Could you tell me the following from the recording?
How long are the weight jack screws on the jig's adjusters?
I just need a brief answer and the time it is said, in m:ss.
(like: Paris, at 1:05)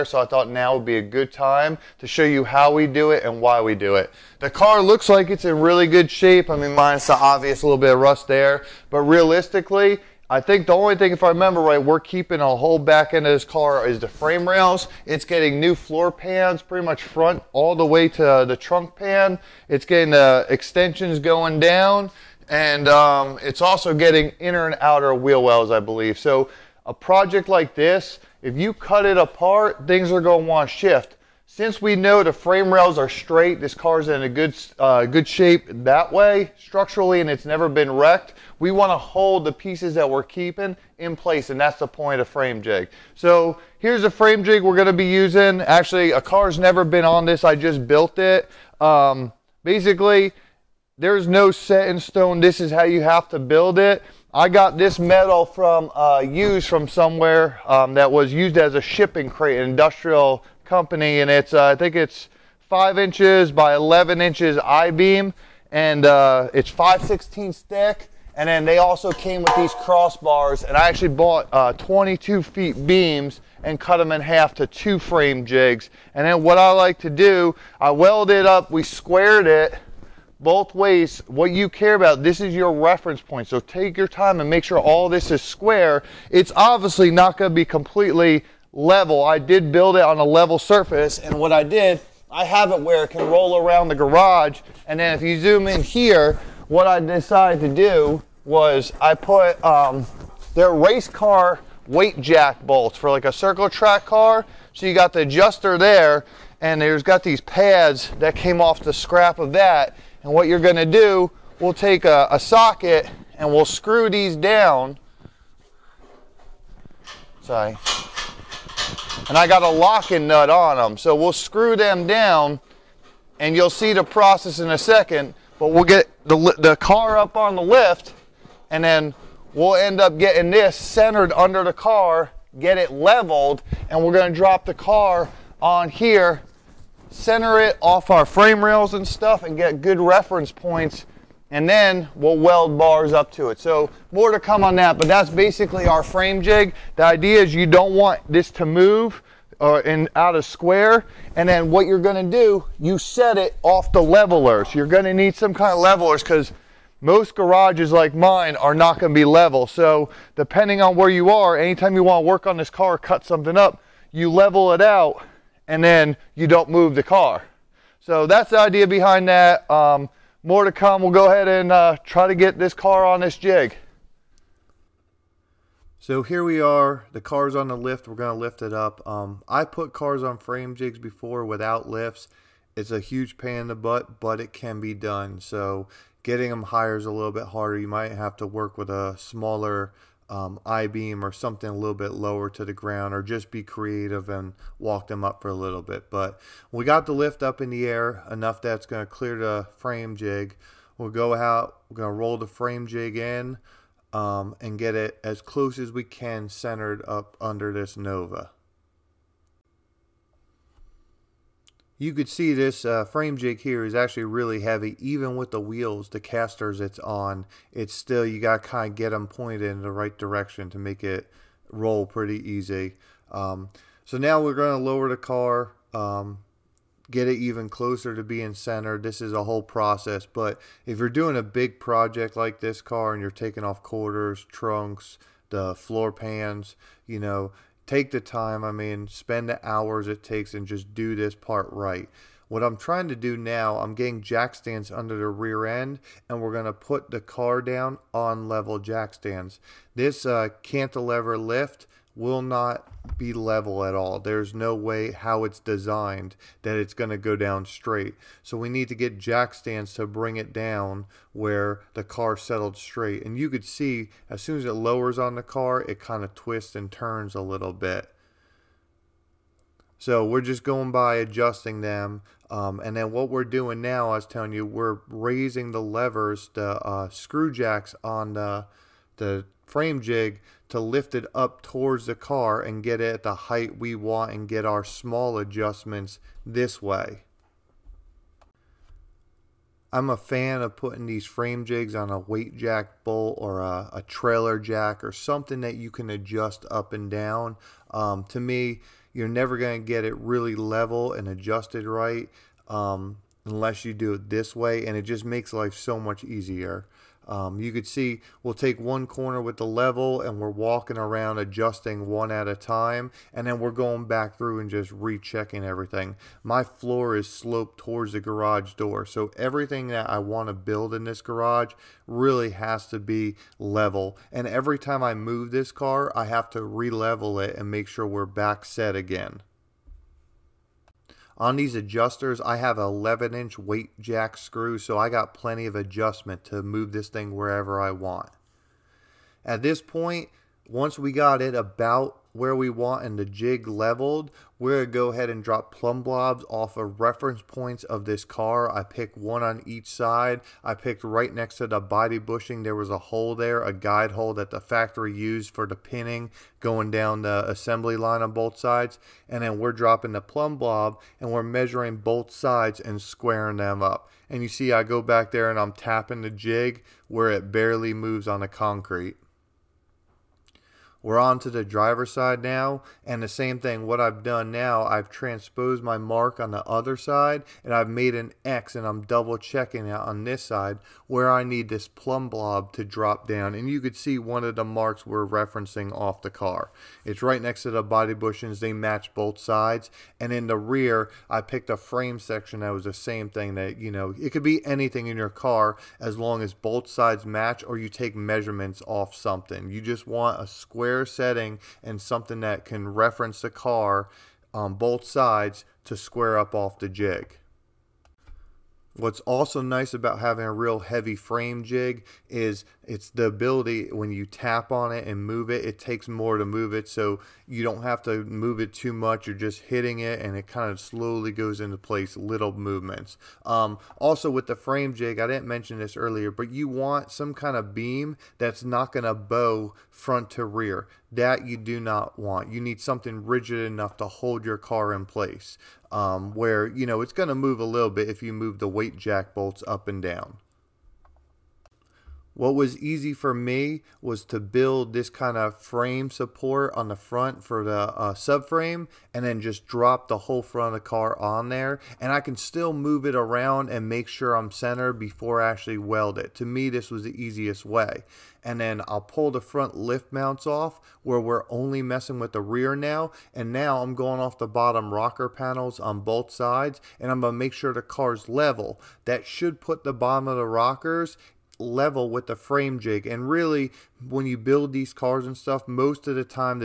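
11 inch, at 5:32.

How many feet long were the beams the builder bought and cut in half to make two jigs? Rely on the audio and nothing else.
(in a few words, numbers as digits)
22.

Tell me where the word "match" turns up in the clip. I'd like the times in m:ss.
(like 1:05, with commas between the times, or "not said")
6:28, 6:37.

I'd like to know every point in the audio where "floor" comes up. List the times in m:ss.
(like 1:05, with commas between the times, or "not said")
0:15, 3:55, 5:16.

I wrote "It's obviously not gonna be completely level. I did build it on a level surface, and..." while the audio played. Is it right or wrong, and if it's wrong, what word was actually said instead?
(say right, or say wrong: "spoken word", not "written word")
right.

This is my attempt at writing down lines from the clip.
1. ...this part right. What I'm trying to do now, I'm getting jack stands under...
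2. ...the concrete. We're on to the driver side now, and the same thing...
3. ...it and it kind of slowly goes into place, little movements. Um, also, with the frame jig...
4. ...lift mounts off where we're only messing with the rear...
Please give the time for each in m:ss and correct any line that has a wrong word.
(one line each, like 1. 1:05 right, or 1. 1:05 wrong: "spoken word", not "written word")
1. 4:01 right
2. 6:08 right
3. 6:59 right
4. 7:39 right.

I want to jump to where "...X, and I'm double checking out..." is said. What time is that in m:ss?
6:18.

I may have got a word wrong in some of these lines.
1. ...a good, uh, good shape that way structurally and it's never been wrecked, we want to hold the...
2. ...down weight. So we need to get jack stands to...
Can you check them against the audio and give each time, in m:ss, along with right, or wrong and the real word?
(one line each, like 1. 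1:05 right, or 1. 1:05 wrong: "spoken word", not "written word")
1. 0:34 right
2. 4:17 wrong: "straight", not "weight".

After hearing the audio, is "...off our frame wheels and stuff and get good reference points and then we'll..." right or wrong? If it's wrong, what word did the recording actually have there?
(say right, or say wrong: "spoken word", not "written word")
wrong: "rails", not "wheels".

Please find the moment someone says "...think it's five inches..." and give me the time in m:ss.
1:01.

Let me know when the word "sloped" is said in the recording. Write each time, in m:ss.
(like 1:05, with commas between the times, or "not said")
5:17.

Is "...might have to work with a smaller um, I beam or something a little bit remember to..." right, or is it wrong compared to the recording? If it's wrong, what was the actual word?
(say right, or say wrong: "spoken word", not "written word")
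wrong: "lower", not "remember".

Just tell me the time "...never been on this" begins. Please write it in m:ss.
0:46.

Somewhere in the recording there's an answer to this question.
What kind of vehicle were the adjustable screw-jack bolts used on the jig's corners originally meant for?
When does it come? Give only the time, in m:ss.
1:43.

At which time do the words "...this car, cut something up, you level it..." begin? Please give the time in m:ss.
2:42.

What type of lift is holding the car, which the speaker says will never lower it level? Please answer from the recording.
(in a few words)
cantilever lift.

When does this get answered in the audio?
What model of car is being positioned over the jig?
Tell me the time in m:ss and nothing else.
3:27.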